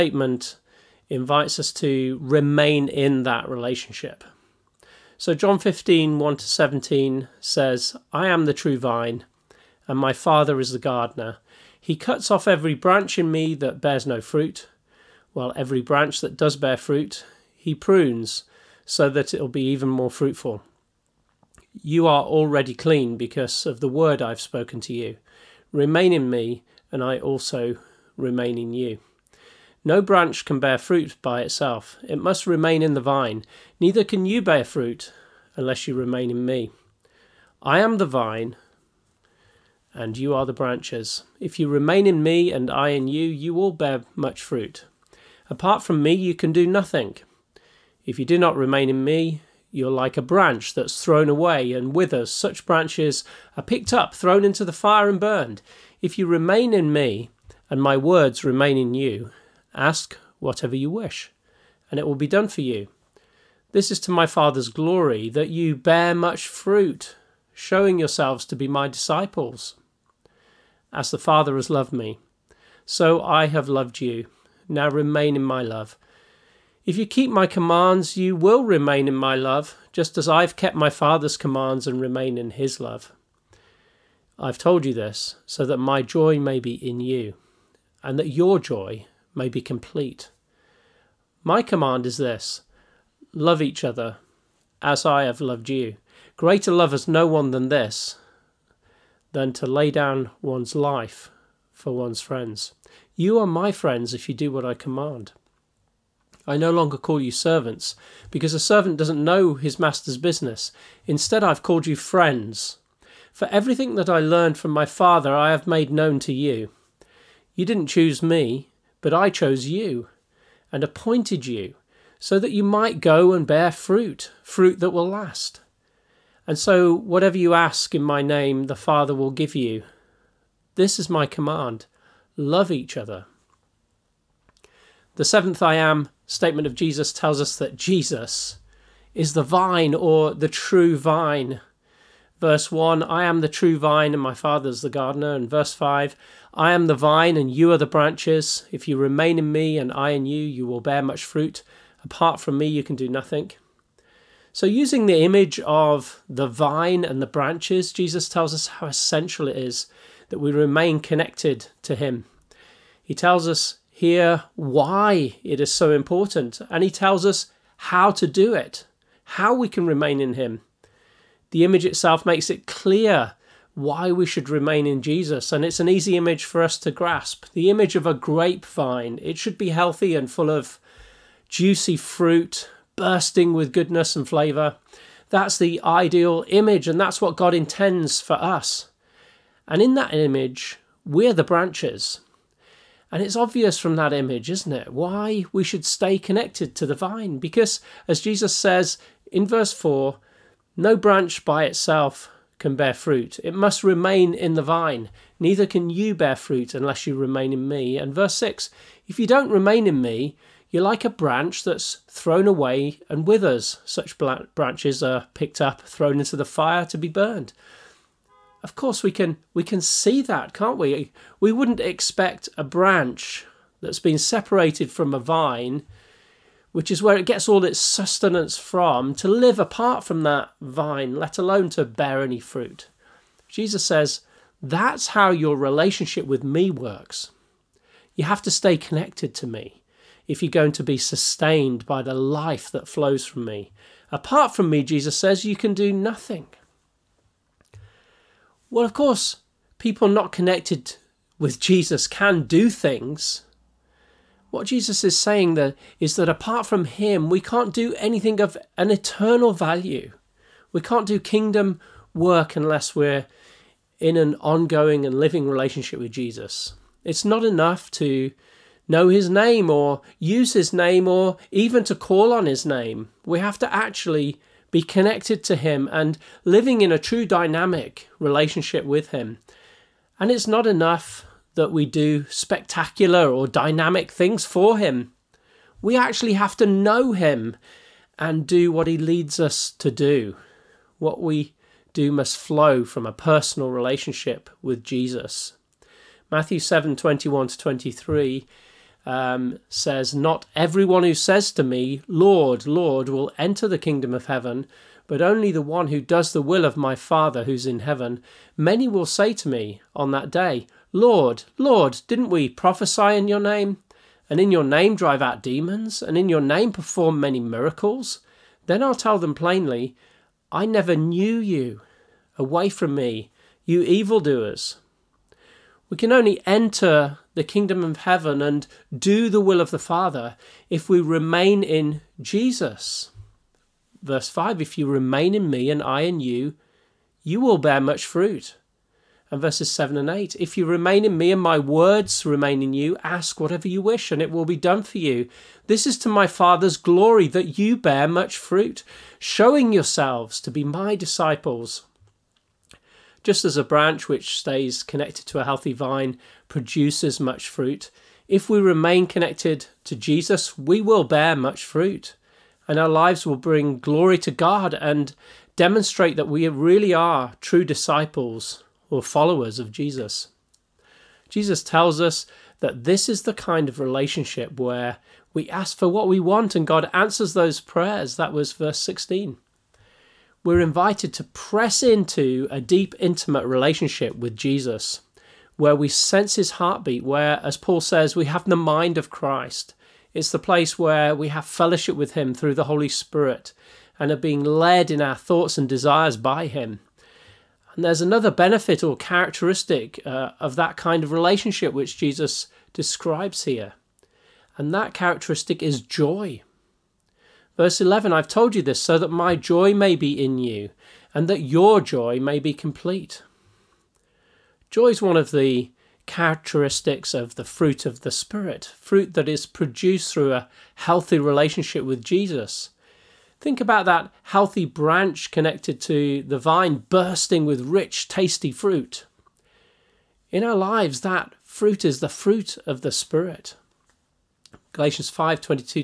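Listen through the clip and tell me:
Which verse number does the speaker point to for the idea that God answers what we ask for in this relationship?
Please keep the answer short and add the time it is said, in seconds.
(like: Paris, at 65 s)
Verse 16, at 378 s.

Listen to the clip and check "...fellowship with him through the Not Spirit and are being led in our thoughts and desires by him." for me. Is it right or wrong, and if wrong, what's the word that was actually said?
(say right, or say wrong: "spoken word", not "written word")
wrong: "Holy", not "Not".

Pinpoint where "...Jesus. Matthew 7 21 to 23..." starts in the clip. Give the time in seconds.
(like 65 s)
294 s.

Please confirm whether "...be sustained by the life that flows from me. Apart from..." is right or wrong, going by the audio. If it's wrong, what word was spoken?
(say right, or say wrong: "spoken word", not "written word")
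right.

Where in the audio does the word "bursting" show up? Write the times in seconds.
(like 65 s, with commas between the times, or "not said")
182 s, 426 s.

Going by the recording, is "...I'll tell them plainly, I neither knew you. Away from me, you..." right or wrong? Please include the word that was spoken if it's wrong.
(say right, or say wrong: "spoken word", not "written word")
wrong: "never", not "neither".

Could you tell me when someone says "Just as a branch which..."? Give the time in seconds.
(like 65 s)
353 s.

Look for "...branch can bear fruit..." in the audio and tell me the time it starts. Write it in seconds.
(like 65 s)
29 s.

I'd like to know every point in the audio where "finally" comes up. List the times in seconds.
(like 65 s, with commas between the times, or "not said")
not said.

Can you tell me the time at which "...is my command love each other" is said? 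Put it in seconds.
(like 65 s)
130 s.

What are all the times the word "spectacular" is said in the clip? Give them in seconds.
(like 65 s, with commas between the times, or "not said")
282 s.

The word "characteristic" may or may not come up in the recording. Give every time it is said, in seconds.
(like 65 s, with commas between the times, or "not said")
398 s, 404 s, 416 s.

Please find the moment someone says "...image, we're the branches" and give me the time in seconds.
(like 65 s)
190 s.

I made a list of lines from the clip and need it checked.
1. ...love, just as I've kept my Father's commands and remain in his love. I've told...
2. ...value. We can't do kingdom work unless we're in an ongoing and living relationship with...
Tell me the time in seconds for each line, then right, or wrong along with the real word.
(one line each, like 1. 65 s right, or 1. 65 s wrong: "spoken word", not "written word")
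1. 79 s right
2. 259 s right.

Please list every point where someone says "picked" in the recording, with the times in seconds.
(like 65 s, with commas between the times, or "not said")
53 s, 215 s.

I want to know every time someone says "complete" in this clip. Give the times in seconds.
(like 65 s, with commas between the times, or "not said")
89 s, 412 s.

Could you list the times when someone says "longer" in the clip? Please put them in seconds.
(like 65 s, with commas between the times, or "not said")
106 s.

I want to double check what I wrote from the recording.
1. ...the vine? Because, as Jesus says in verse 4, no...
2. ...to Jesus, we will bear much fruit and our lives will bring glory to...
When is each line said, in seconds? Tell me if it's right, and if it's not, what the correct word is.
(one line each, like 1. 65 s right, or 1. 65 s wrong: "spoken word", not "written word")
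1. 196 s right
2. 359 s right.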